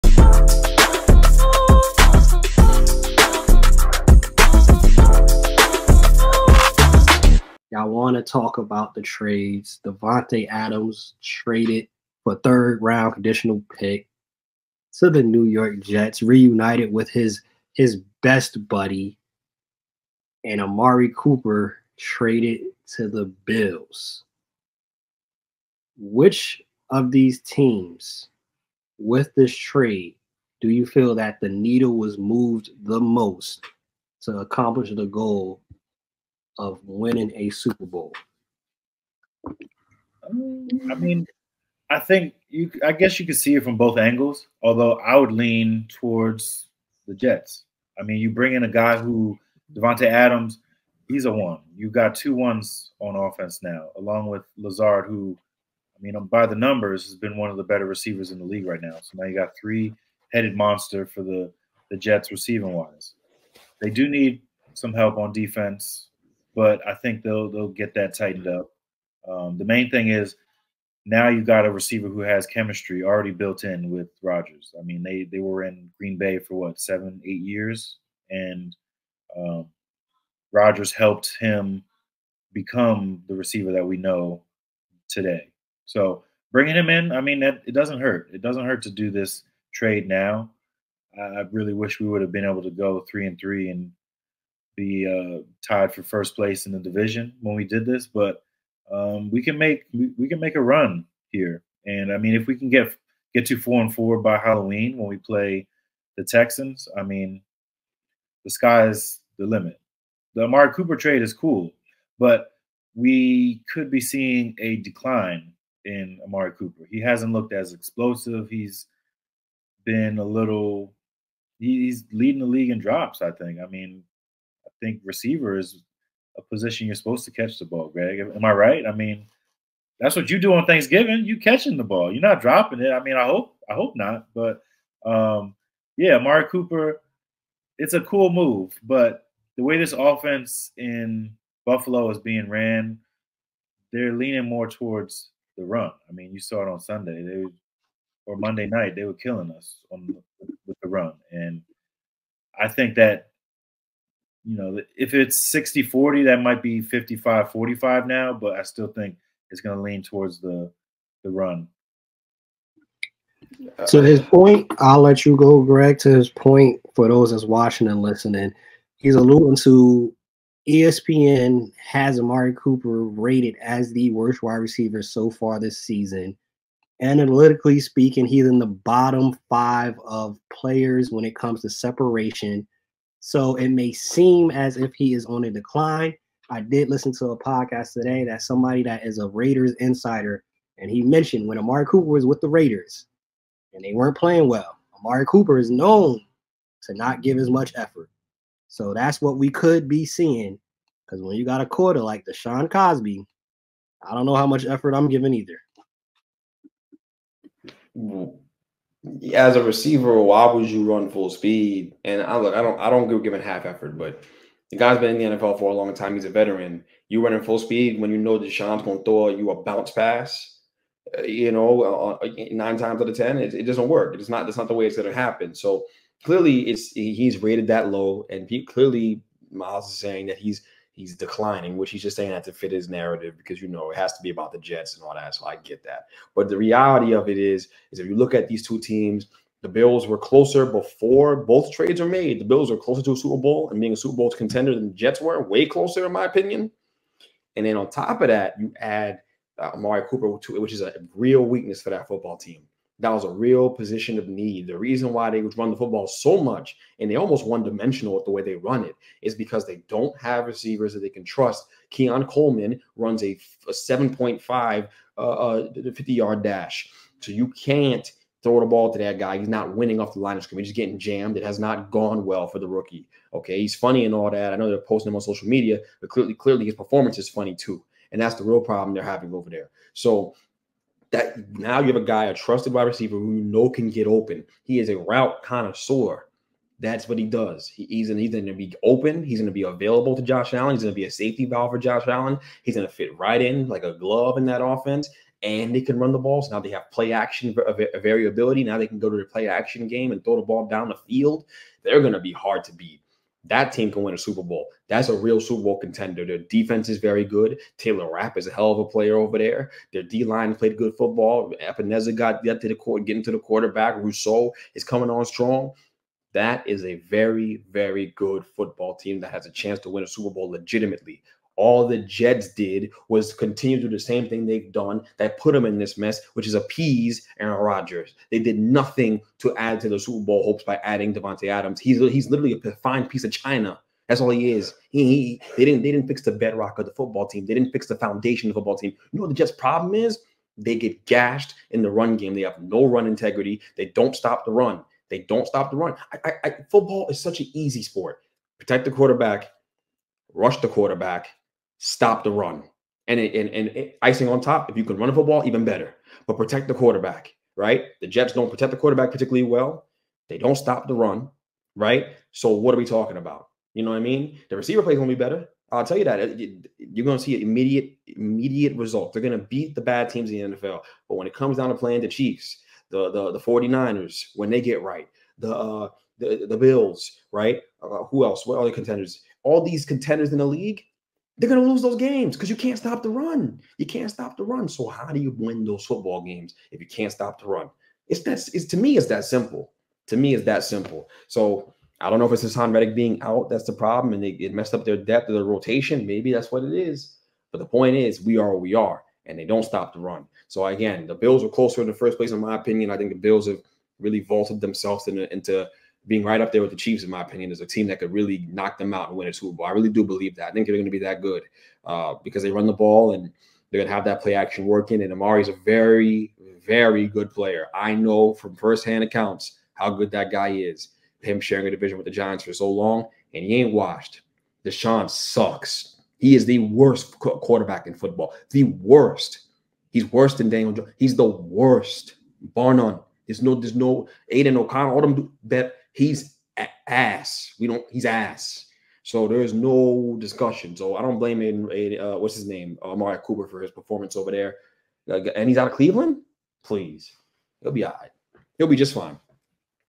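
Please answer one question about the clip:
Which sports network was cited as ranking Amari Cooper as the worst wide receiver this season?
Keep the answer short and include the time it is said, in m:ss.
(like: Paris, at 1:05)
ESPN, at 2:50.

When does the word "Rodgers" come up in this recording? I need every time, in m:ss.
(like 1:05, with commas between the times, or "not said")
1:14, 1:20, 5:27.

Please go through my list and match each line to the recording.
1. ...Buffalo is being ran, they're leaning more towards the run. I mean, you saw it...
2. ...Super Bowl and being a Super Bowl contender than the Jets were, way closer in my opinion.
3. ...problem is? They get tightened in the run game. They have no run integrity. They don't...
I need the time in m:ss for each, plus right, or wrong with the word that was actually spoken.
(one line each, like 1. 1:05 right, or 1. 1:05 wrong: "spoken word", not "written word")
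1. 2:21 right
2. 4:03 right
3. 5:39 wrong: "gashed", not "tightened".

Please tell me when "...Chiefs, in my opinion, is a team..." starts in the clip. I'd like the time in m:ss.
6:46.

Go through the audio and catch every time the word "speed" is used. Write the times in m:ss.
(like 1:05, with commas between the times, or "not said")
3:31, 3:37.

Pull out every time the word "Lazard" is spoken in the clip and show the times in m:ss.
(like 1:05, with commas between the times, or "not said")
0:54.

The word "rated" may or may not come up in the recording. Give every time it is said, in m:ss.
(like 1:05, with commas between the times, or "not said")
2:53, 3:47.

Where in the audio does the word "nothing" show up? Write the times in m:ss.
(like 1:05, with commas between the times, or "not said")
5:28.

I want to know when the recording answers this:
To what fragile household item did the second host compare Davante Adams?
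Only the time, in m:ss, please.
5:32.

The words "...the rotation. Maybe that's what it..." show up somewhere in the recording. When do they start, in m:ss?
6:35.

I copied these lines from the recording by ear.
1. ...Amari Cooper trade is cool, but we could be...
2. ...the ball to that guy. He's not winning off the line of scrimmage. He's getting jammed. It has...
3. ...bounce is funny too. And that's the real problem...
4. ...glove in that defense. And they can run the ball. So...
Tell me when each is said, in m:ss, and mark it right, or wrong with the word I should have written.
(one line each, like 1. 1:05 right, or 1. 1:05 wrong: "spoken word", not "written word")
1. 1:50 right
2. 4:28 right
3. 4:36 wrong: "performance", not "bounce"
4. 4:53 wrong: "offense", not "defense".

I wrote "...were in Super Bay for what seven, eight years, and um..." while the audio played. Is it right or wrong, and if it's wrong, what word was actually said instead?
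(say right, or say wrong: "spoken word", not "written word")
wrong: "Green", not "Super".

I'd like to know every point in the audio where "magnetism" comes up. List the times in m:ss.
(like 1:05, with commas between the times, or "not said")
not said.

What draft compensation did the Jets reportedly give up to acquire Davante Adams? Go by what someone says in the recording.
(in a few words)
Third round conditional pick.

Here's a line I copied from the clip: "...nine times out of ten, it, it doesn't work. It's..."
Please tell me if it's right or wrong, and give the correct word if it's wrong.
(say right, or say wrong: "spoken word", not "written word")
right.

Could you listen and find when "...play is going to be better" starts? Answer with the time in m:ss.
6:04.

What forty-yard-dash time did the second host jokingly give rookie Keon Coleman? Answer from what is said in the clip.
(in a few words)
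7.5.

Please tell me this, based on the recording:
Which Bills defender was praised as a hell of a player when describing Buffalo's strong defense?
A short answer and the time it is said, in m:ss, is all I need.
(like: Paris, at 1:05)
Taylor Rapp, at 5:07.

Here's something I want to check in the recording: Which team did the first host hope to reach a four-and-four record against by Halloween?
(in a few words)
Texans.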